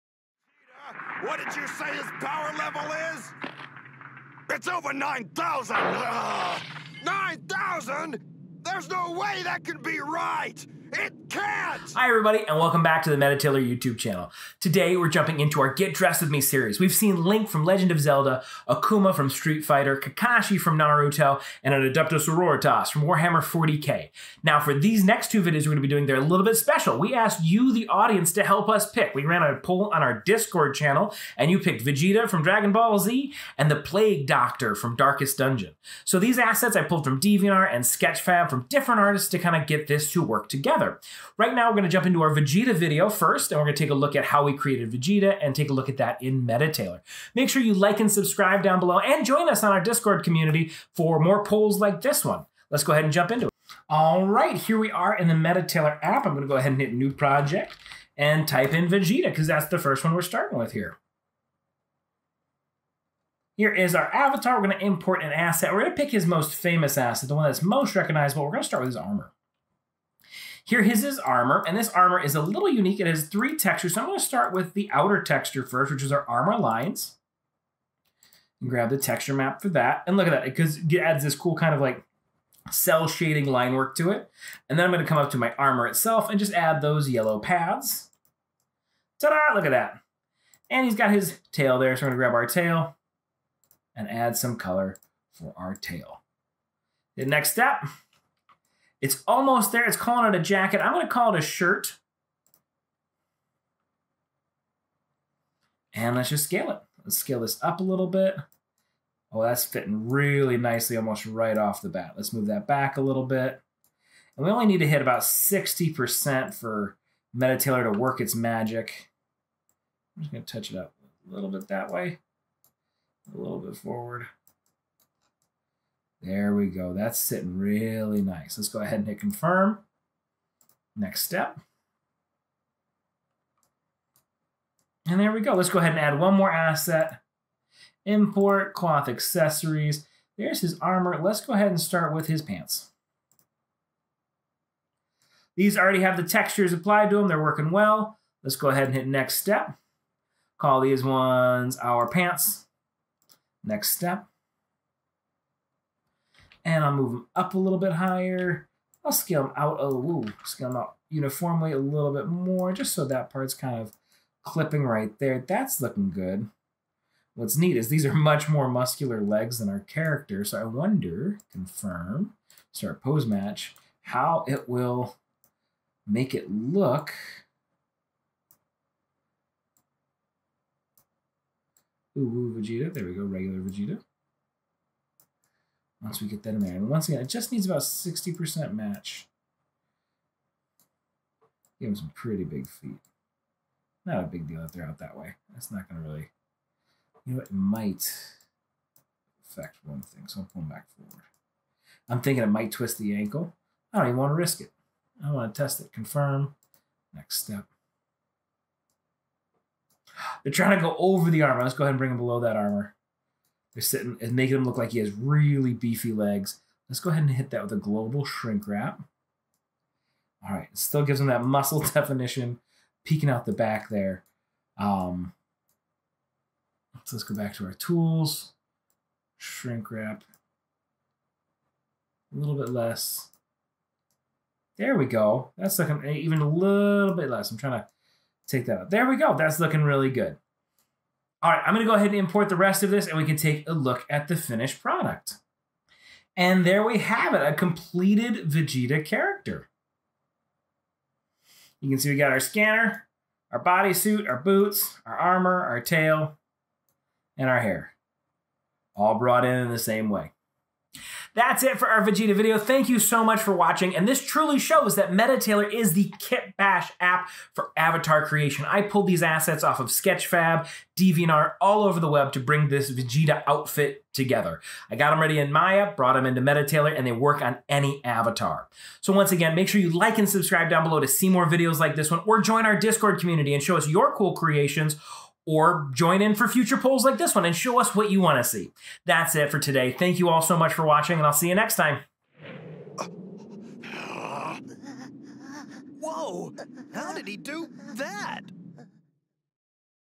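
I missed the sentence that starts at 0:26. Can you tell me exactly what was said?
We asked you, the audience, to help us pick.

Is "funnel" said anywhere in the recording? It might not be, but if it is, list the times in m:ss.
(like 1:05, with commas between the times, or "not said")
not said.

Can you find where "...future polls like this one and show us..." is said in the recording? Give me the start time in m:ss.
4:46.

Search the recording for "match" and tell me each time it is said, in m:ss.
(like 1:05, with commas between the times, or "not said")
2:53, 3:08.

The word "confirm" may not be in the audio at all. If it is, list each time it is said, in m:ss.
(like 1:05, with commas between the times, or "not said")
2:09, 2:51, 3:25.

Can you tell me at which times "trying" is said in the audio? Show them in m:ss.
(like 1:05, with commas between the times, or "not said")
3:30, 3:57.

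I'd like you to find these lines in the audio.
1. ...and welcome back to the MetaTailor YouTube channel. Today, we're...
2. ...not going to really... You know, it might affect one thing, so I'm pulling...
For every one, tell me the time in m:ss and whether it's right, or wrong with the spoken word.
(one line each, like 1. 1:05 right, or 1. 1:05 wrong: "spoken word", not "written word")
1. 0:12 right
2. 3:15 right.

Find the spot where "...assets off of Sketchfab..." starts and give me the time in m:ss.
4:29.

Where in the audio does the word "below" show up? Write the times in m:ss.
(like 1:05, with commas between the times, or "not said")
0:48, 3:32, 4:40.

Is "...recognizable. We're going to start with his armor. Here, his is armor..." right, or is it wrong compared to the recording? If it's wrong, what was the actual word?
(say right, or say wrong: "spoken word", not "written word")
right.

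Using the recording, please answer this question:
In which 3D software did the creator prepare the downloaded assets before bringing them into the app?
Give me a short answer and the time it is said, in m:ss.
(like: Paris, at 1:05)
Maya, at 4:35.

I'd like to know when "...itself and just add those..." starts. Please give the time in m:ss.
1:25.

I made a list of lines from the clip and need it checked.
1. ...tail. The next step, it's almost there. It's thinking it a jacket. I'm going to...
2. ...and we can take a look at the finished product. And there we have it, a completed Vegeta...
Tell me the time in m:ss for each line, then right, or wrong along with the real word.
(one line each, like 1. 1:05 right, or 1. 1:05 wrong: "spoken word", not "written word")
1. 1:35 wrong: "calling", not "thinking"
2. 4:03 right.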